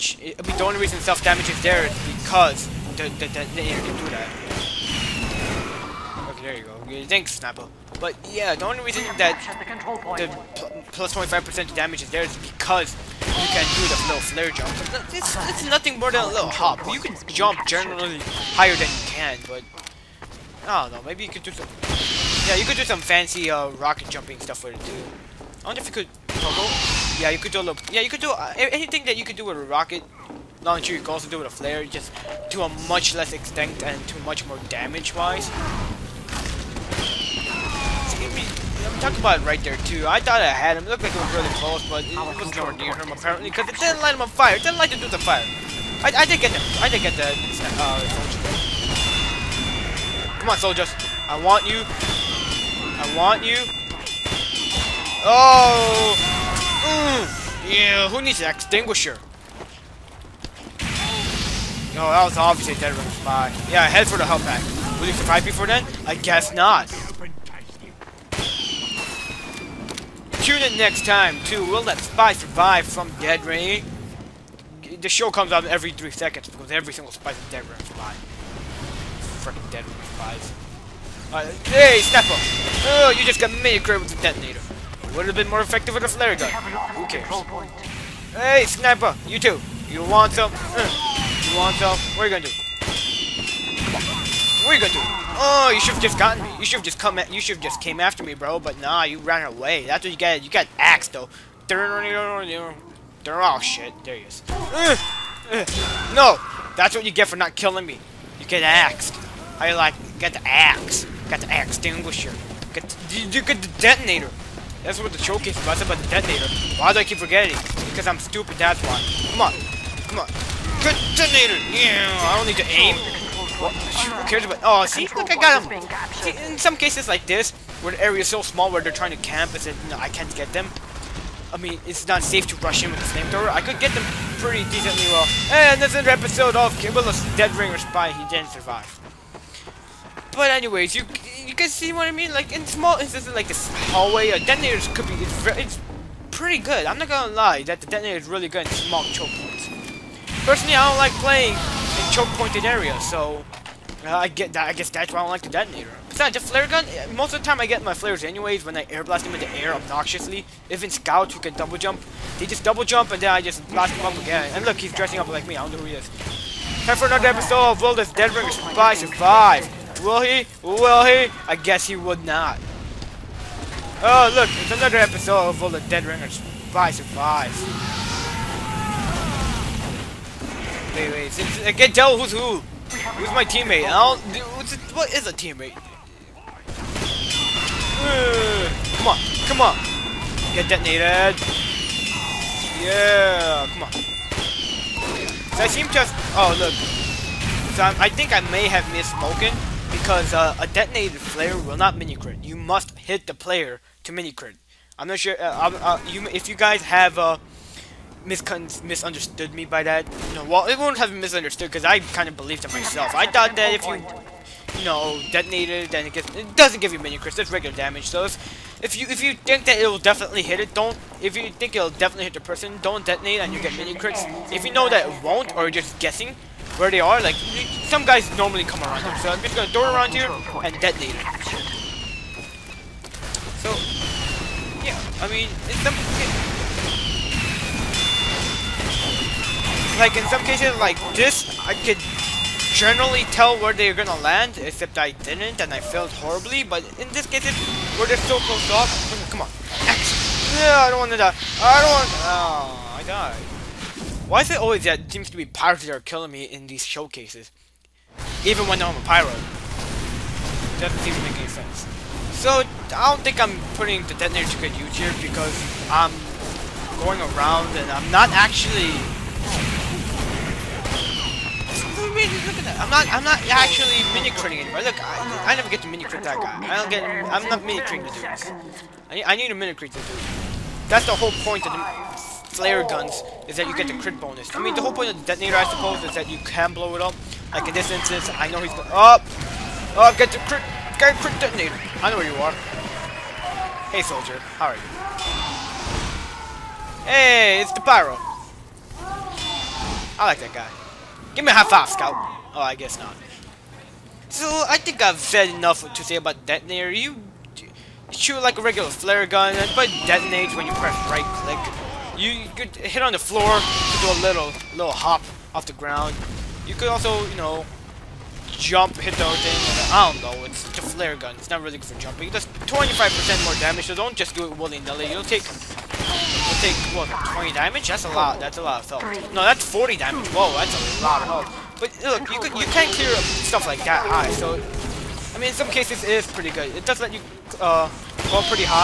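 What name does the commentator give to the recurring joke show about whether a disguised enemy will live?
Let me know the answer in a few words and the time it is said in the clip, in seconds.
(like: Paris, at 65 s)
Will That Spy Survive, at 71 s.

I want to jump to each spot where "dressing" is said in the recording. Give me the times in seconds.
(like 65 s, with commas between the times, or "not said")
164 s.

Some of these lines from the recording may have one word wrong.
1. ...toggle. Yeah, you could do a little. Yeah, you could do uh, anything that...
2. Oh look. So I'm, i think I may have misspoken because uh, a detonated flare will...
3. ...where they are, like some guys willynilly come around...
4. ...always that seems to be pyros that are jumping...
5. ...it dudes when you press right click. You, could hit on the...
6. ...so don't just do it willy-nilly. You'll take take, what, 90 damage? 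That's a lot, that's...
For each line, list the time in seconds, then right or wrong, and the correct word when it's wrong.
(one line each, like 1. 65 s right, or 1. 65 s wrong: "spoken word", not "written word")
1. 26 s right
2. 196 s right
3. 226 s wrong: "normally", not "willynilly"
4. 254 s wrong: "killing", not "jumping"
5. 309 s wrong: "detonates", not "dudes"
6. 323 s wrong: "20", not "90".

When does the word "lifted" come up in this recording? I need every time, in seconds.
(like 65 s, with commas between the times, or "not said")
not said.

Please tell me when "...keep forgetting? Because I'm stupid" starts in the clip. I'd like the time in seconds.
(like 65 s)
117 s.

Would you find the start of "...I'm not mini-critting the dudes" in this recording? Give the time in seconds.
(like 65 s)
277 s.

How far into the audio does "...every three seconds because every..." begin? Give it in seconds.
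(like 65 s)
75 s.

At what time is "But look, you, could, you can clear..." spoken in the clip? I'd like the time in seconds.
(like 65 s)
331 s.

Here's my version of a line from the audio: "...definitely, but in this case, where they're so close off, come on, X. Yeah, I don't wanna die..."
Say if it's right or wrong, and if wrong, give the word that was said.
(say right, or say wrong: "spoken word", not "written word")
wrong: "horribly", not "definitely".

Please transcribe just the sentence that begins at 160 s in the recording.
Even scouts who can double jump, they just double jump and then I just blast them up again.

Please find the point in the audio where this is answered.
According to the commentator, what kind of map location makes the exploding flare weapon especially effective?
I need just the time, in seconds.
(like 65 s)
148 s.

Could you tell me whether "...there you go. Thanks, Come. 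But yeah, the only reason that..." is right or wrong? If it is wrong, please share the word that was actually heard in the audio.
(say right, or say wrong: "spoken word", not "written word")
wrong: "Snapple", not "Come".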